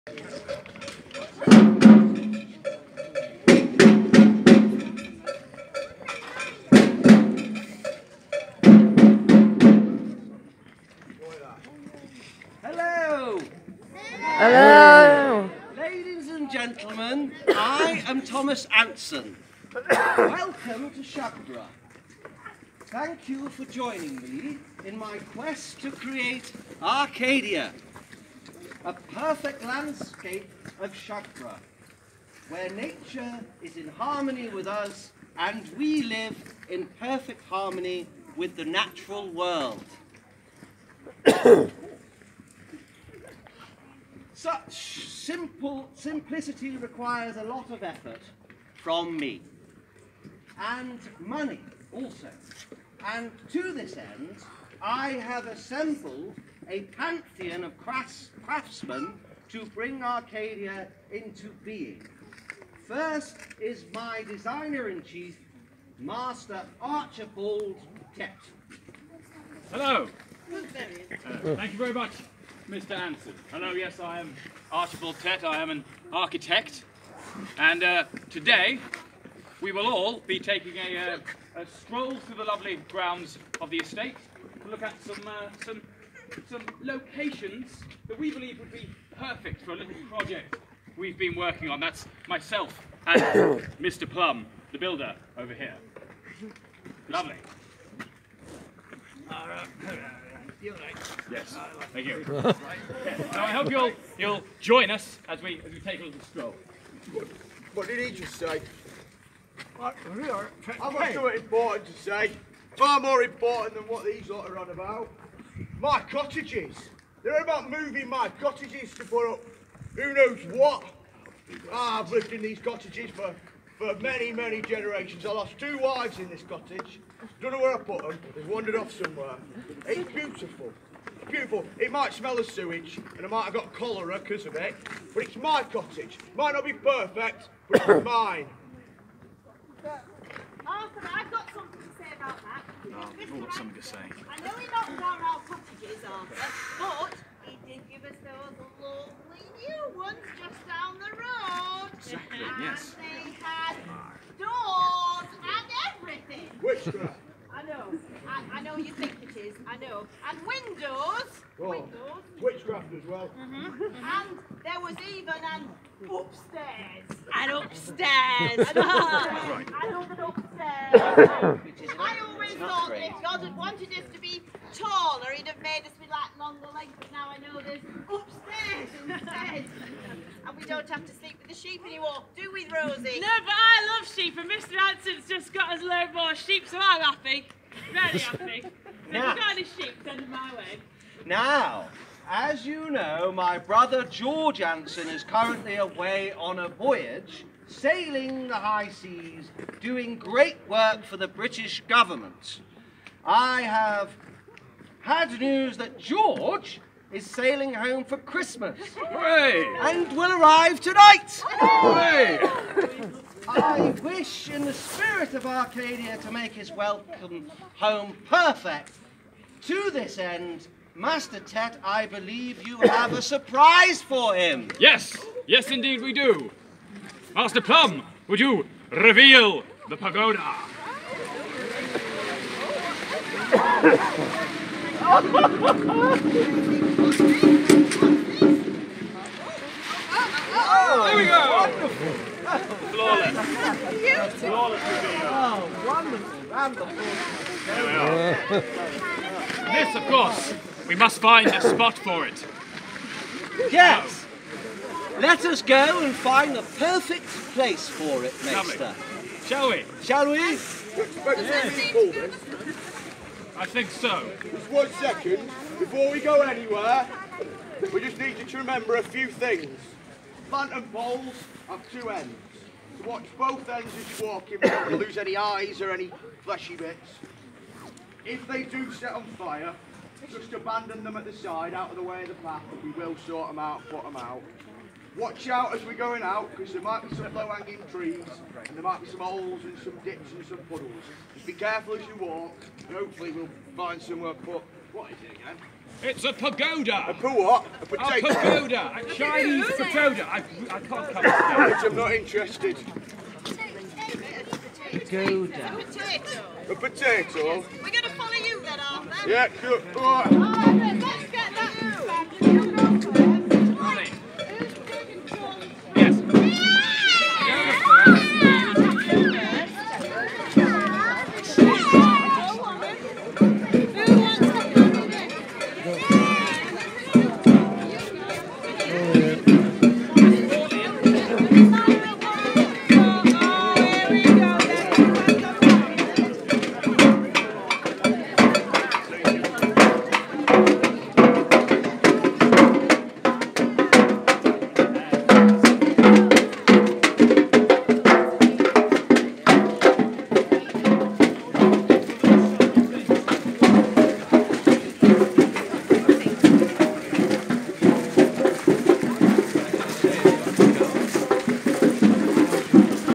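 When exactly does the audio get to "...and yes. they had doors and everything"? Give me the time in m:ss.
2:32.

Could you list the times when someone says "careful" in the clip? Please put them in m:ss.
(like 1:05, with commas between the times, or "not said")
4:51.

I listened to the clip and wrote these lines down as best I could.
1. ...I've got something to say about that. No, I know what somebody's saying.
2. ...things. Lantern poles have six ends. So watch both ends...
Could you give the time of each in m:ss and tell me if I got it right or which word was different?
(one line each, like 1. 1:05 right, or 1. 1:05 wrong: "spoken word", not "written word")
1. 2:21 right
2. 4:29 wrong: "two", not "six".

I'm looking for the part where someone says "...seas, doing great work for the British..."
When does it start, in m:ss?
3:18.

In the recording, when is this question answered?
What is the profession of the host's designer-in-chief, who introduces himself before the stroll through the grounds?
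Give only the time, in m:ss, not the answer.
1:16.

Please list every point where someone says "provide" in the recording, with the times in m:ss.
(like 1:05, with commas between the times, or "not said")
not said.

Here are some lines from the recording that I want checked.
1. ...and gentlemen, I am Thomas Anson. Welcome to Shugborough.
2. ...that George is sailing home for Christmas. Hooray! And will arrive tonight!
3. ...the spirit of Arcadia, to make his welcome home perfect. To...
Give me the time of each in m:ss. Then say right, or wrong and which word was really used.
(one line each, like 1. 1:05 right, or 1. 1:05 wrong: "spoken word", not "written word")
1. 0:16 right
2. 3:25 right
3. 3:34 right.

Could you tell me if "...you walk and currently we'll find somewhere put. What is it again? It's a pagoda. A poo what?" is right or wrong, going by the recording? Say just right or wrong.
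wrong.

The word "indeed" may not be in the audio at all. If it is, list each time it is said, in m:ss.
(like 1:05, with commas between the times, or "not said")
3:45.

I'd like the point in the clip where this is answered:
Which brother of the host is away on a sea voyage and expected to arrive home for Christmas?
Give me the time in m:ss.
3:14.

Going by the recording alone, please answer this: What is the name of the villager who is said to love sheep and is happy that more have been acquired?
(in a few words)
Rosie.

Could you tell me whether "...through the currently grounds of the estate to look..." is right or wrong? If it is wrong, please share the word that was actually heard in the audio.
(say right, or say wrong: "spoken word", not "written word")
wrong: "lovely", not "currently".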